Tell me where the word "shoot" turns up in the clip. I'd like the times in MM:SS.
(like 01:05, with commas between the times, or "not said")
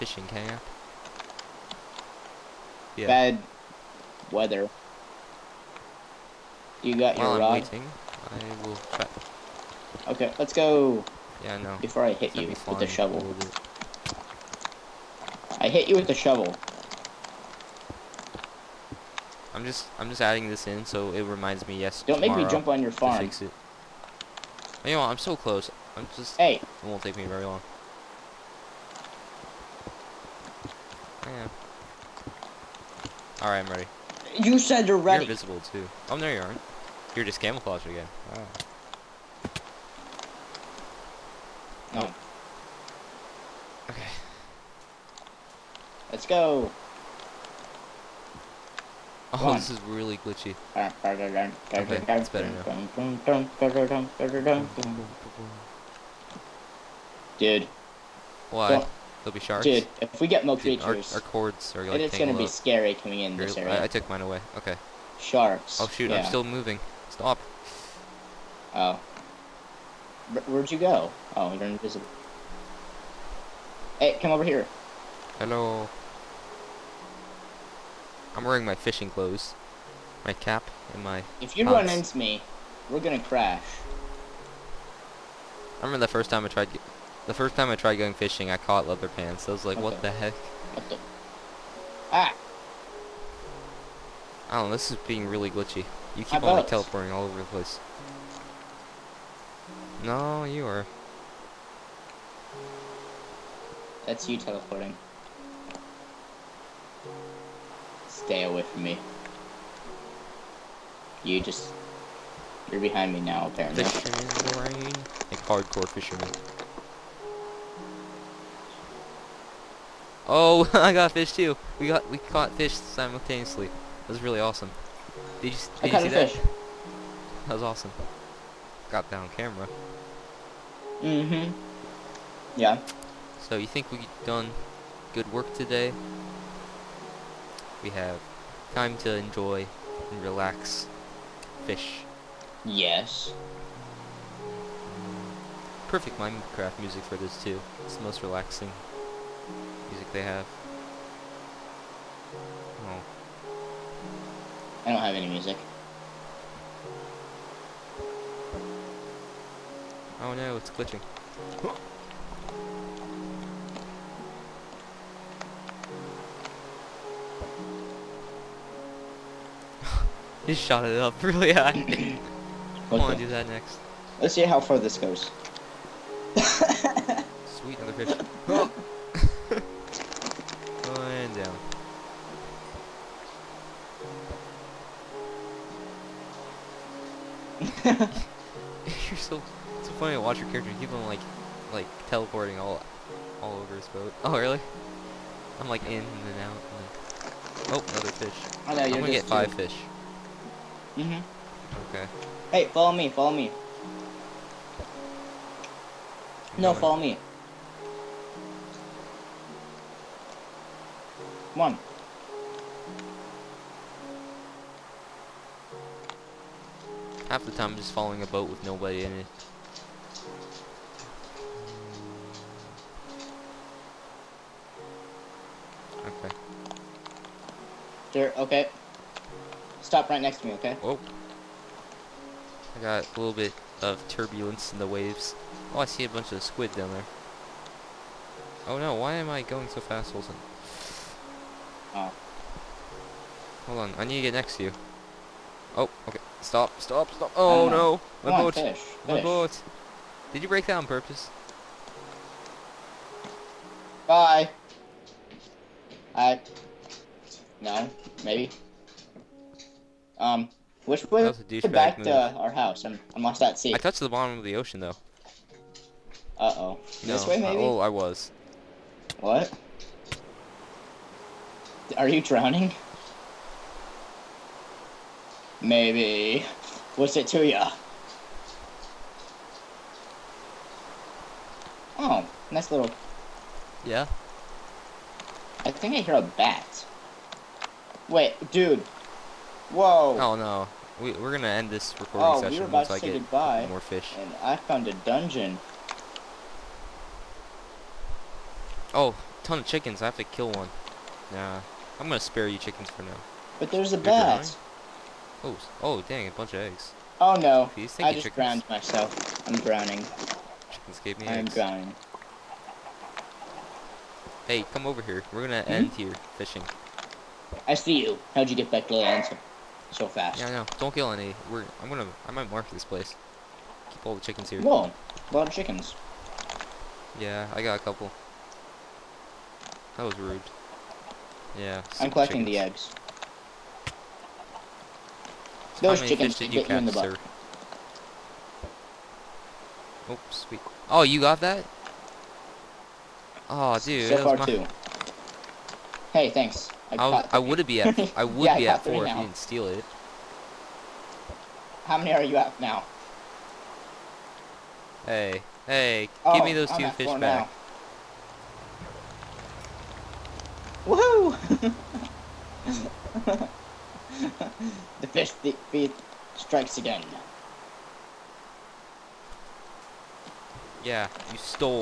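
01:05.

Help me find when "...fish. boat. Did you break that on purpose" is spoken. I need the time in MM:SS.
04:09.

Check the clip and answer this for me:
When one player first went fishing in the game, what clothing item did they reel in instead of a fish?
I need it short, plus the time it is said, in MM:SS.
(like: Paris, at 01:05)
leather pants, at 01:28.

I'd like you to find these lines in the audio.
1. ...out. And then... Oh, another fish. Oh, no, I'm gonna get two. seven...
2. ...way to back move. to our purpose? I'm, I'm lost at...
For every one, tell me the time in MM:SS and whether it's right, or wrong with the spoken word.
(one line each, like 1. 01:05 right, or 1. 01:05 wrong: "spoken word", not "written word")
1. 03:16 wrong: "five", not "seven"
2. 04:21 wrong: "house", not "purpose".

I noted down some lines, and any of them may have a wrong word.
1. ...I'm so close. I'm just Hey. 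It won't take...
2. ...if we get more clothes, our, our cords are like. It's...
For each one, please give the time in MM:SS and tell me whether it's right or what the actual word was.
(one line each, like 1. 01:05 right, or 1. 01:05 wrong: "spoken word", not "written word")
1. 00:25 right
2. 01:00 wrong: "creatures", not "clothes".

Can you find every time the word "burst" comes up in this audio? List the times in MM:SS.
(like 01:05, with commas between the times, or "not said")
not said.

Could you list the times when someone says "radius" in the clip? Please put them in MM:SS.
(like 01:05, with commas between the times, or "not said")
not said.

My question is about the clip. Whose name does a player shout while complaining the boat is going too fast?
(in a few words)
Wilson.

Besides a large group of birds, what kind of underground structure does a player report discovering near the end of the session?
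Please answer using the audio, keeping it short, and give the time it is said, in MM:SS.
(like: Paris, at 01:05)
a dungeon, at 04:54.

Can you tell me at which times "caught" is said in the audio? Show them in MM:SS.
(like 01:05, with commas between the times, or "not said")
01:28, 02:02.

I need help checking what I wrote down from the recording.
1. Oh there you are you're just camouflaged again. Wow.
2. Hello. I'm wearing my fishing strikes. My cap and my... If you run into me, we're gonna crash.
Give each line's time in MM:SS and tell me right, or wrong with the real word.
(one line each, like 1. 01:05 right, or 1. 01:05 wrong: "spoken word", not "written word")
1. 00:36 right
2. 01:15 wrong: "clothes", not "strikes".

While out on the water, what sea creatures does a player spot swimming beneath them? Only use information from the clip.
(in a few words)
squid.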